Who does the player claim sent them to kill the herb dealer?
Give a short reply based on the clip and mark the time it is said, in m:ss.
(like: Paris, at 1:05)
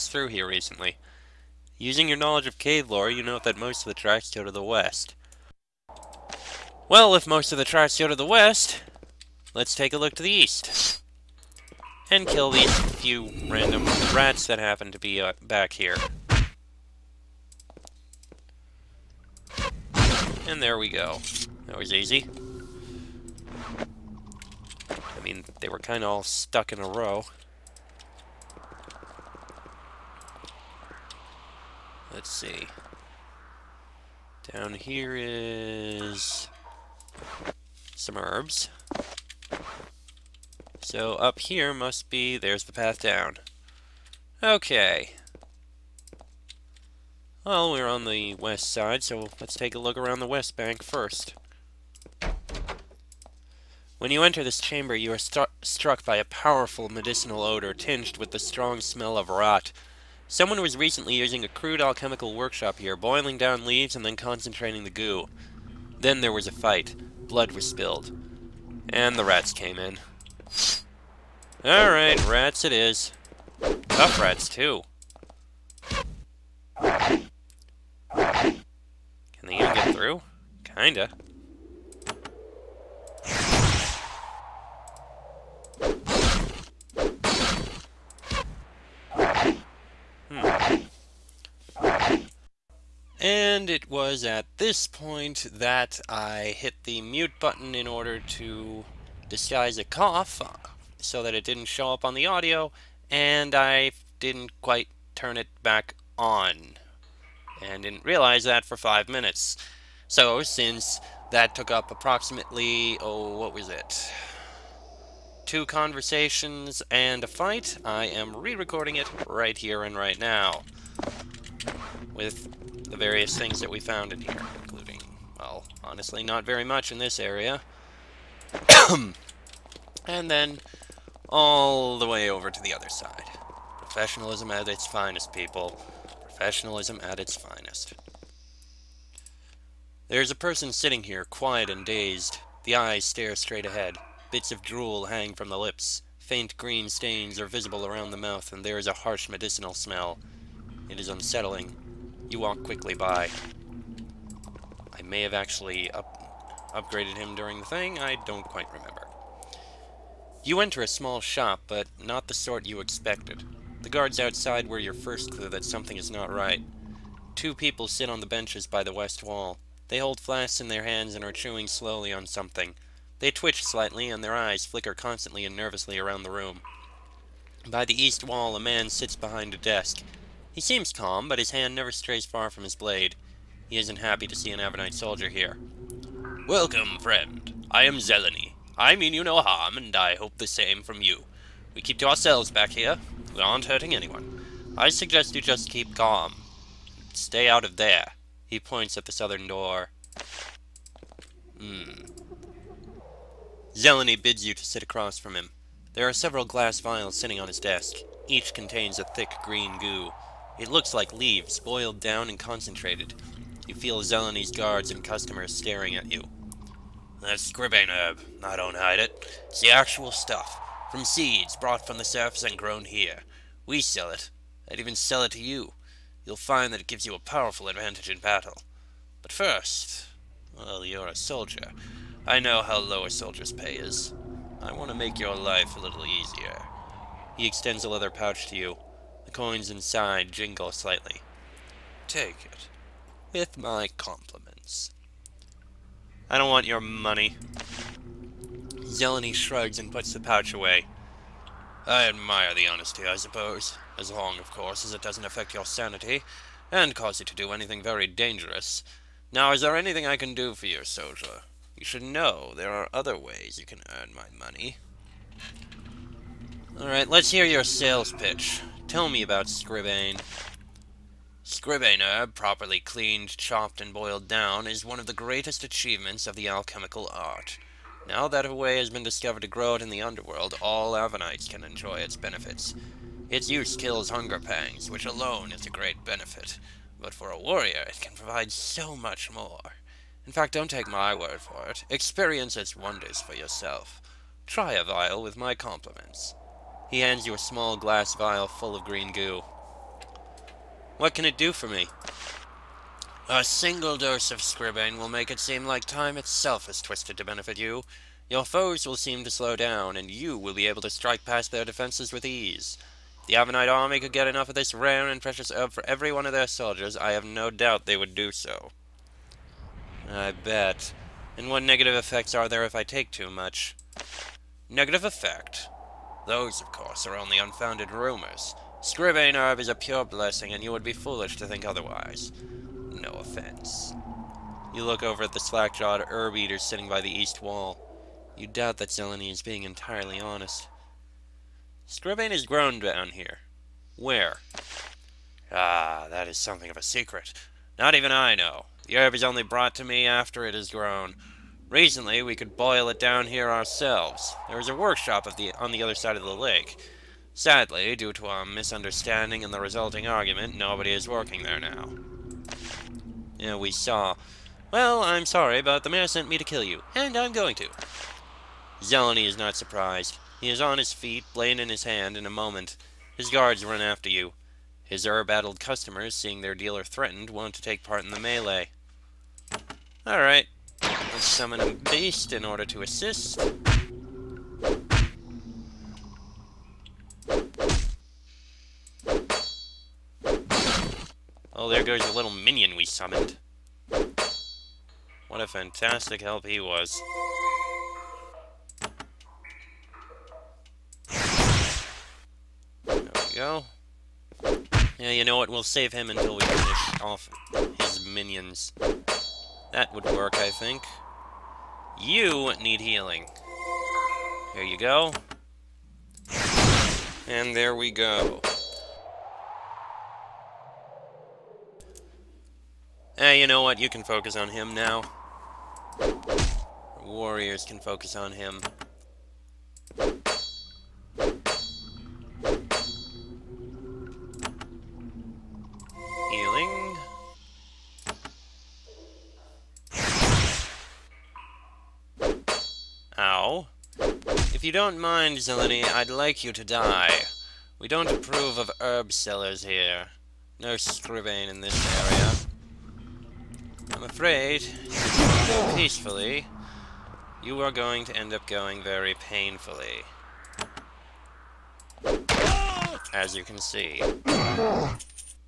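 The mayor, at 6:05.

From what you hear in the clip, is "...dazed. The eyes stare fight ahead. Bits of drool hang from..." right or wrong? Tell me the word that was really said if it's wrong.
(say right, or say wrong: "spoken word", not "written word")
wrong: "straight", not "fight".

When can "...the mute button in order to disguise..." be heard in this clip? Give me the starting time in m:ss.
1:36.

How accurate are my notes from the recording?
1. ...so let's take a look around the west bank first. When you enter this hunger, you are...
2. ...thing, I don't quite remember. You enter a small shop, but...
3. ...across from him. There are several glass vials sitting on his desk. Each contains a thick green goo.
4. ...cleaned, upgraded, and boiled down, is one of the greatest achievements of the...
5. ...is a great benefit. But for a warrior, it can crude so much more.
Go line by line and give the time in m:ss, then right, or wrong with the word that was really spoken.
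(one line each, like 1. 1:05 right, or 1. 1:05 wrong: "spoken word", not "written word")
1. 0:49 wrong: "chamber", not "hunger"
2. 2:37 right
3. 3:24 right
4. 4:32 wrong: "chopped", not "upgraded"
5. 4:45 wrong: "provide", not "crude".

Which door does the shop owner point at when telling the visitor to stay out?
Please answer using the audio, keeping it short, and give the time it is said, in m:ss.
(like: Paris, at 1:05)
The southern door, at 3:19.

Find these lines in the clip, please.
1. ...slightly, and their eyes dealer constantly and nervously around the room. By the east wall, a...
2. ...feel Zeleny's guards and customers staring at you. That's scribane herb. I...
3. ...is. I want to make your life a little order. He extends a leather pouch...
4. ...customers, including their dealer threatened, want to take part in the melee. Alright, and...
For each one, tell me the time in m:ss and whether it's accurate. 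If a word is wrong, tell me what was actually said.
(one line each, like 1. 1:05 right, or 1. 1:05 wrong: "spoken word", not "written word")
1. 2:53 wrong: "flicker", not "dealer"
2. 3:33 right
3. 3:53 wrong: "easier", not "order"
4. 6:15 wrong: "seeing", not "including".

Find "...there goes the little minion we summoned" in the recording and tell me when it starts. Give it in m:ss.
6:31.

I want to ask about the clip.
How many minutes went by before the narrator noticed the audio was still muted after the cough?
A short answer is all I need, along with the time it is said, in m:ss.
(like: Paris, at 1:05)
5, at 1:48.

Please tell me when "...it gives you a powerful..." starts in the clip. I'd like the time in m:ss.
3:46.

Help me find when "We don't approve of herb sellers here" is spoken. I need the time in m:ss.
7:27.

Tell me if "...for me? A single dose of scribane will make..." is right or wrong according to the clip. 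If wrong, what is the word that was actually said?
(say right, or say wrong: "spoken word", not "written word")
right.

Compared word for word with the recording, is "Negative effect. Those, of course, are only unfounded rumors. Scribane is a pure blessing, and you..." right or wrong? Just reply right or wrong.
right.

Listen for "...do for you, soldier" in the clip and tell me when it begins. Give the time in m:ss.
4:20.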